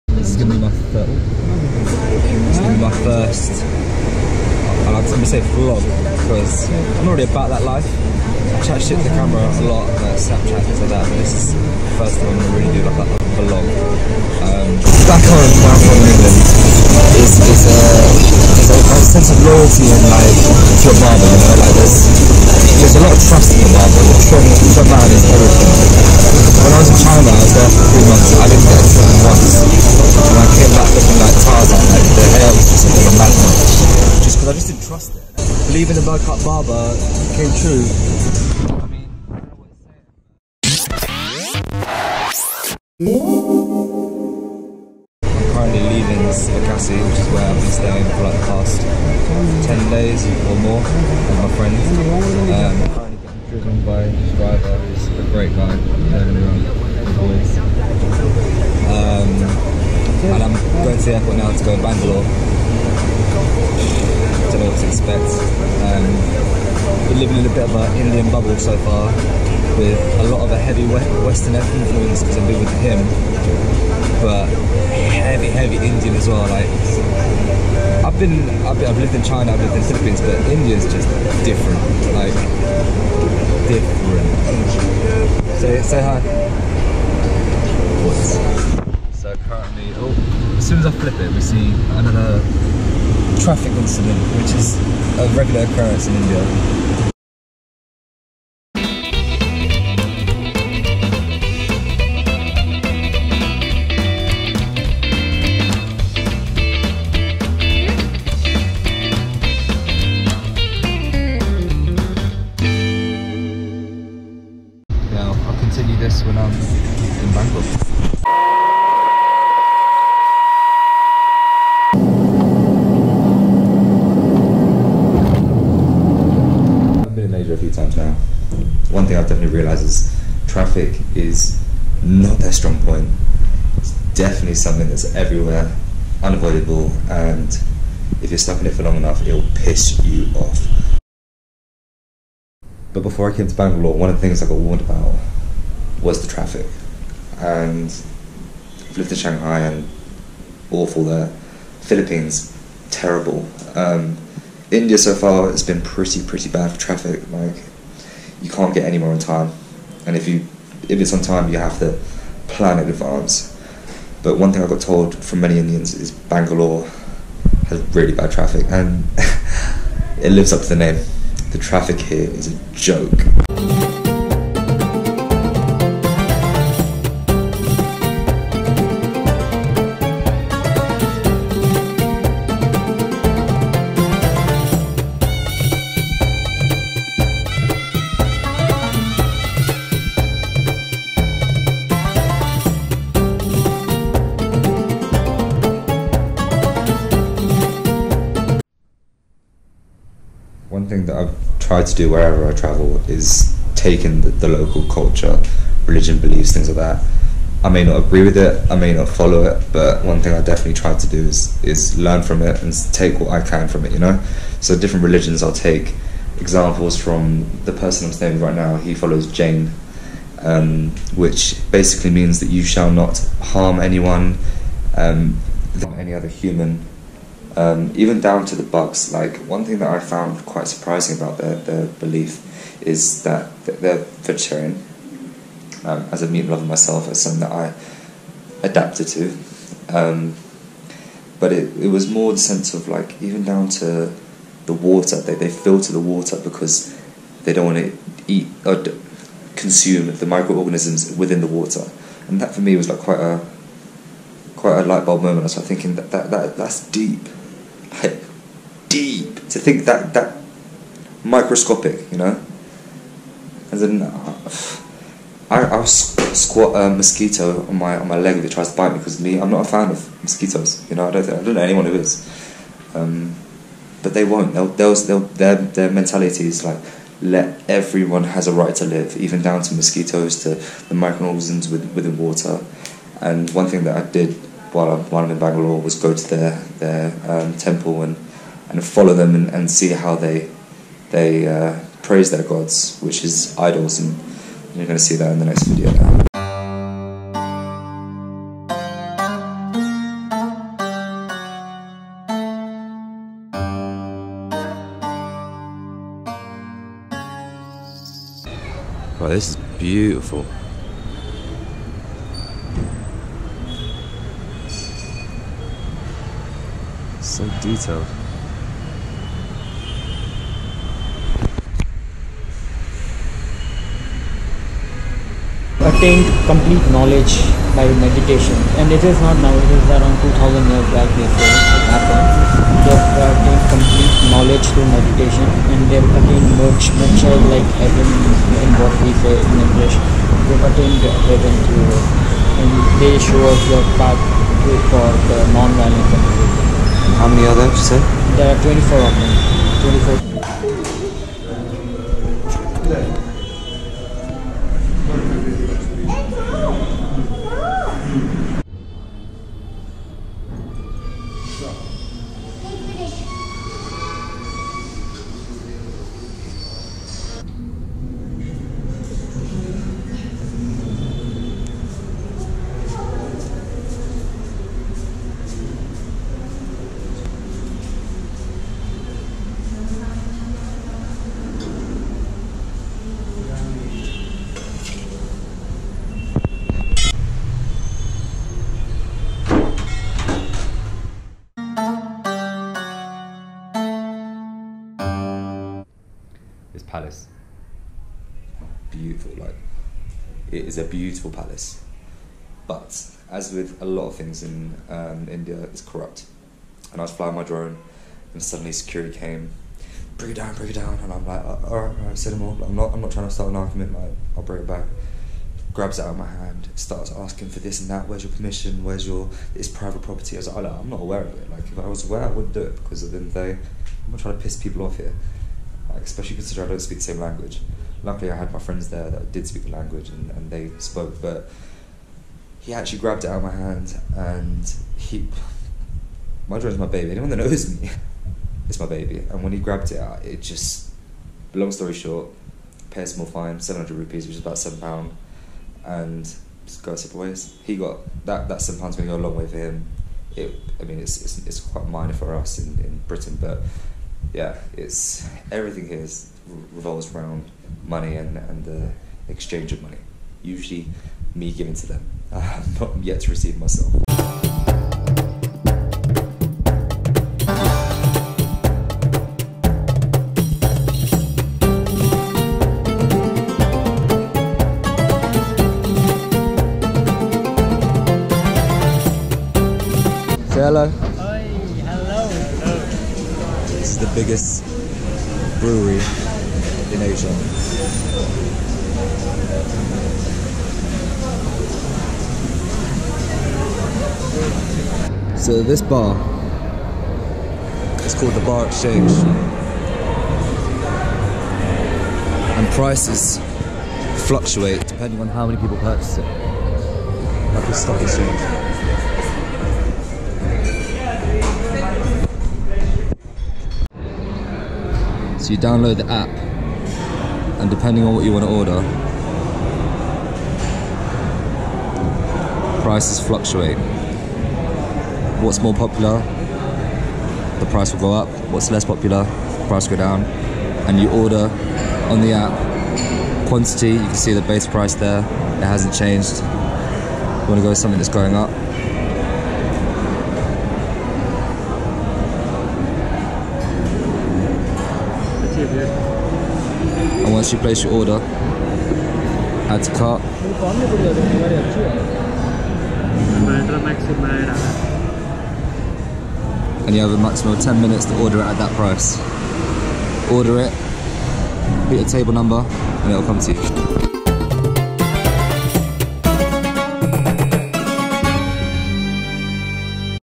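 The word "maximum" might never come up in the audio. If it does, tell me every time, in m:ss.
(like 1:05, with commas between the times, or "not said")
9:17.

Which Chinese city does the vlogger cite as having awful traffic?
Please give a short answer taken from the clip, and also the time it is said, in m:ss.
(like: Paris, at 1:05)
Shanghai, at 2:29.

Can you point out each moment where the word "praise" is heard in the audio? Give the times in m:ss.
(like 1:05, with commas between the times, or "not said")
4:52.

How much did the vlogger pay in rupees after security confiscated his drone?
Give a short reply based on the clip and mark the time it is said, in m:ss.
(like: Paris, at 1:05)
700 rupees, at 7:23.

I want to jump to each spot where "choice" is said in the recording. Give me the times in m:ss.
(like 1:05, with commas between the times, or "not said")
not said.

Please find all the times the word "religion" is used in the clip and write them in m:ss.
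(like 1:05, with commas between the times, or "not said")
3:25, 3:35.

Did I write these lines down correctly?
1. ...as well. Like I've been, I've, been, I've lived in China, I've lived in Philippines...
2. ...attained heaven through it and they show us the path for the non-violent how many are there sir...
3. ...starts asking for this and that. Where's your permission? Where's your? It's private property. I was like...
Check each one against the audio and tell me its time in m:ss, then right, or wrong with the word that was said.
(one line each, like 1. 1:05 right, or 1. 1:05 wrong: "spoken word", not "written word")
1. 1:16 right
2. 5:40 right
3. 6:56 right.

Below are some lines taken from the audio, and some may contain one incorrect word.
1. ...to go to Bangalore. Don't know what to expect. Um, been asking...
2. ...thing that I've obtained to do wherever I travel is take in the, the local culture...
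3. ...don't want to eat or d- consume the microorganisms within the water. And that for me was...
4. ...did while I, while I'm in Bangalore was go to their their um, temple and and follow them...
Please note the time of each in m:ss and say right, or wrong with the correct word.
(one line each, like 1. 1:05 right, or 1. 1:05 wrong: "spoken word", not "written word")
1. 1:01 wrong: "living", not "asking"
2. 3:20 wrong: "tried", not "obtained"
3. 4:07 right
4. 4:44 right.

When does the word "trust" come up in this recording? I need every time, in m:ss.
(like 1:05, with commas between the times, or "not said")
0:23, 0:34.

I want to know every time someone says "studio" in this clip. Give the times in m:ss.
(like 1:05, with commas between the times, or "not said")
not said.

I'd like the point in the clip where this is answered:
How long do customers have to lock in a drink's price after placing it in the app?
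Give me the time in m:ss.
9:17.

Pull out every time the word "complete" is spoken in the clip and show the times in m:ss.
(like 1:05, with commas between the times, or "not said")
5:26, 5:33.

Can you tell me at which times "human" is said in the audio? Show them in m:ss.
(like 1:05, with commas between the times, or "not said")
3:46.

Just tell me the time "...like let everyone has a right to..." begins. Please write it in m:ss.
4:36.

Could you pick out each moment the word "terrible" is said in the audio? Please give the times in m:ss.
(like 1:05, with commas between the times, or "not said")
2:32.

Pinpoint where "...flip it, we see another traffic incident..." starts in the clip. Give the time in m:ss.
1:30.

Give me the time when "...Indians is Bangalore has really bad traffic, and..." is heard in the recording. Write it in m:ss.
2:45.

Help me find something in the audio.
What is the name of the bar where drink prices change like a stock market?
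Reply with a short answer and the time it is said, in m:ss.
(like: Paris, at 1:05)
Bar Exchange, at 8:18.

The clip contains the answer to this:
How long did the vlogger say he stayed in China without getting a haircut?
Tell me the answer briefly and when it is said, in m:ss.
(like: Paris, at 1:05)
3 months, at 0:27.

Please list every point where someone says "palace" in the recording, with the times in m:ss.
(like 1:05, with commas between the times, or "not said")
6:36, 6:41.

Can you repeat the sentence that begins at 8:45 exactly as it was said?
What's more popular, the price will go up.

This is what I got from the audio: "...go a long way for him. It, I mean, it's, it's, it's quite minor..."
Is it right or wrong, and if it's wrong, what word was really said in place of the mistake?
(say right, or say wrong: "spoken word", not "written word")
right.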